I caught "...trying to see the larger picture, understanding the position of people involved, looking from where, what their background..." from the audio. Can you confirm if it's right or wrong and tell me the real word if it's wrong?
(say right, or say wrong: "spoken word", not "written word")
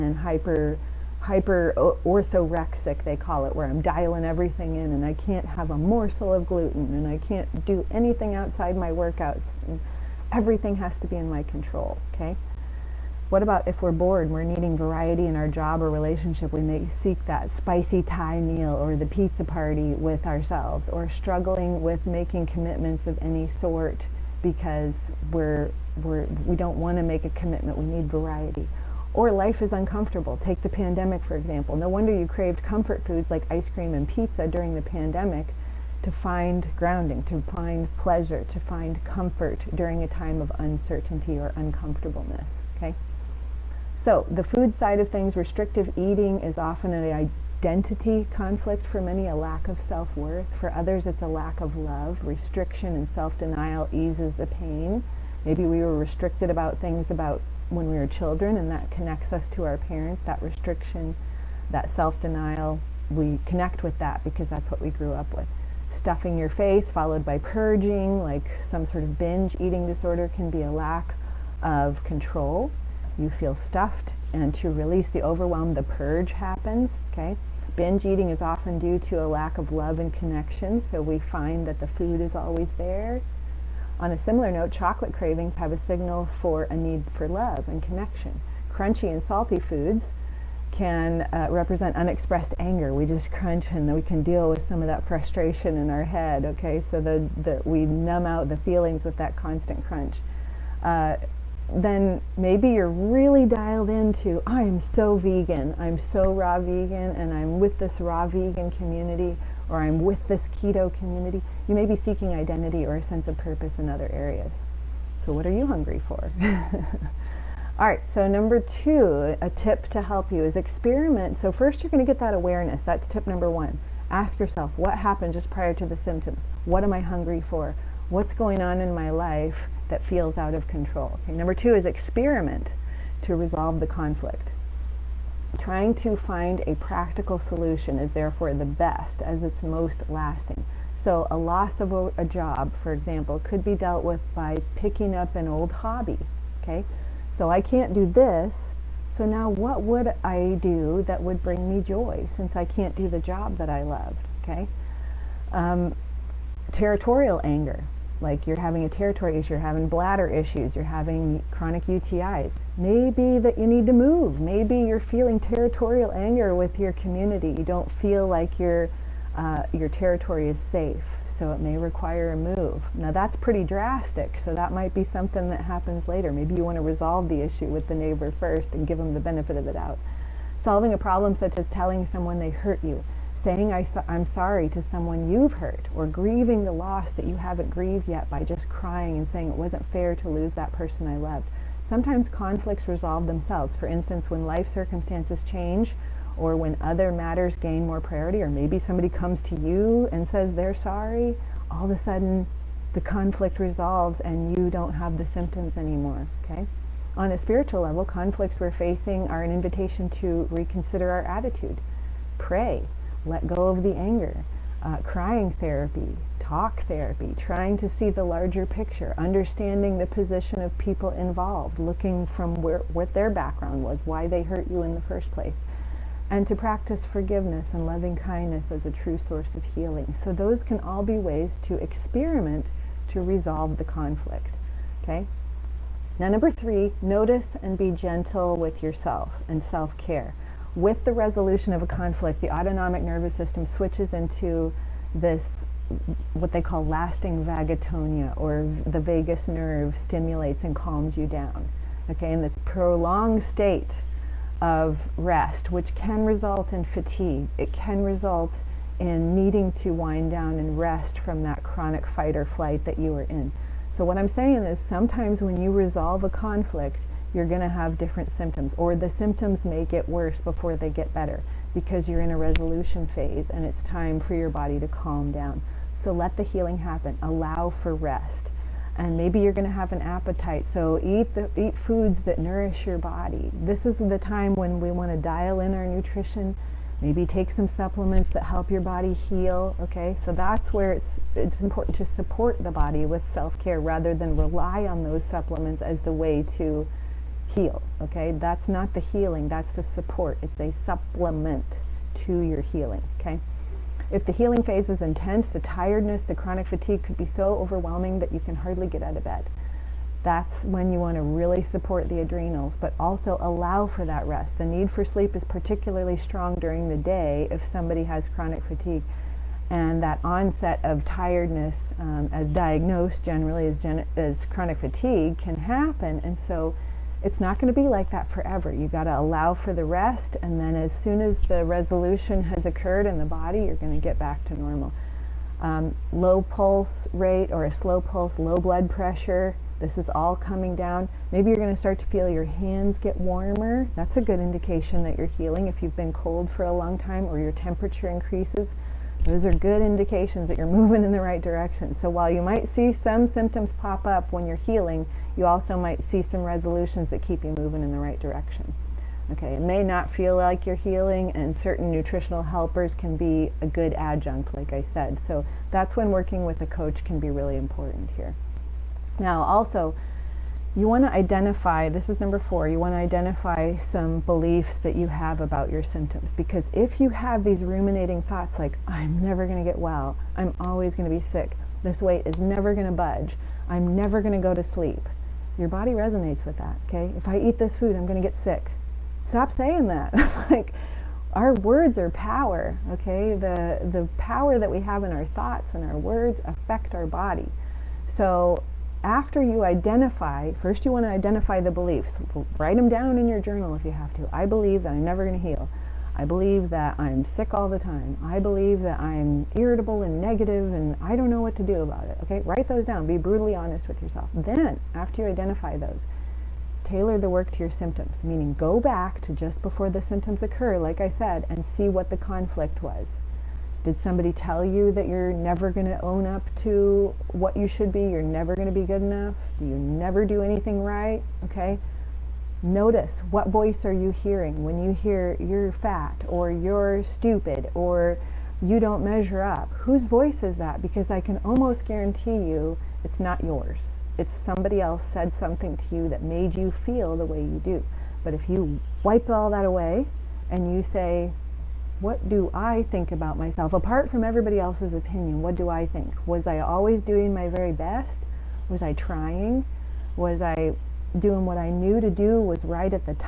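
right.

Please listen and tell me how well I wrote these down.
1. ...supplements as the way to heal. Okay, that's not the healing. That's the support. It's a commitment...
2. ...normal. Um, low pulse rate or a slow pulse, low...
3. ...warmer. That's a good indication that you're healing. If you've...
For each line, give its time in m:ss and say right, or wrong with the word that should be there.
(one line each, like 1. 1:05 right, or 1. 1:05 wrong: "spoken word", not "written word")
1. 4:55 wrong: "supplement", not "commitment"
2. 5:34 right
3. 5:43 right.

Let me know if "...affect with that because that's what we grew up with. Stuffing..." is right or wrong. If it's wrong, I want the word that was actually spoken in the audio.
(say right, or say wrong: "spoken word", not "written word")
wrong: "connect", not "affect".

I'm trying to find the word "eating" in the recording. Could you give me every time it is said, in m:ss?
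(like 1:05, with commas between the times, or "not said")
0:45, 1:09, 1:18.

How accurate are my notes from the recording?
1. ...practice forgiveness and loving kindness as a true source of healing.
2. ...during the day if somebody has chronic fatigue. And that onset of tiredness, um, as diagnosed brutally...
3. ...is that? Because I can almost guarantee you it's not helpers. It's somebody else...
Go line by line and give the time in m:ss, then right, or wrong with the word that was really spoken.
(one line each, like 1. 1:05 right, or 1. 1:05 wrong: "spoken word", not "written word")
1. 3:46 right
2. 5:16 wrong: "generally", not "brutally"
3. 7:20 wrong: "yours", not "helpers".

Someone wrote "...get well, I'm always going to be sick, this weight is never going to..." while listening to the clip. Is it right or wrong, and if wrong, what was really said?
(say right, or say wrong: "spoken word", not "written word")
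right.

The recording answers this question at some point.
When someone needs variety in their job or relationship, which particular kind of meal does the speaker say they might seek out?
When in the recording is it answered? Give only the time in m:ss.
0:17.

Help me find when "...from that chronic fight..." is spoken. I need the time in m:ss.
4:21.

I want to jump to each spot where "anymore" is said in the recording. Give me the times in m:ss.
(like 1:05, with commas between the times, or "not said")
3:25.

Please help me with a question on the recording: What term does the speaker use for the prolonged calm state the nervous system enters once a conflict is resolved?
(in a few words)
Vagotonia.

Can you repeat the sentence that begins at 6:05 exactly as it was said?
So that's when working with a coach can be really important here.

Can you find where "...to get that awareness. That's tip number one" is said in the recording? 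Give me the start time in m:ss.
2:02.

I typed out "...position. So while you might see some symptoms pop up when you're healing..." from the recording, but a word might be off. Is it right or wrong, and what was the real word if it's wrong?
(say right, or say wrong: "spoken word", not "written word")
wrong: "direction", not "position".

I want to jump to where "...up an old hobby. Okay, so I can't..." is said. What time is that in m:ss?
2:25.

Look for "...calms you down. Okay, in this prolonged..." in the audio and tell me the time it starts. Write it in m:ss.
4:10.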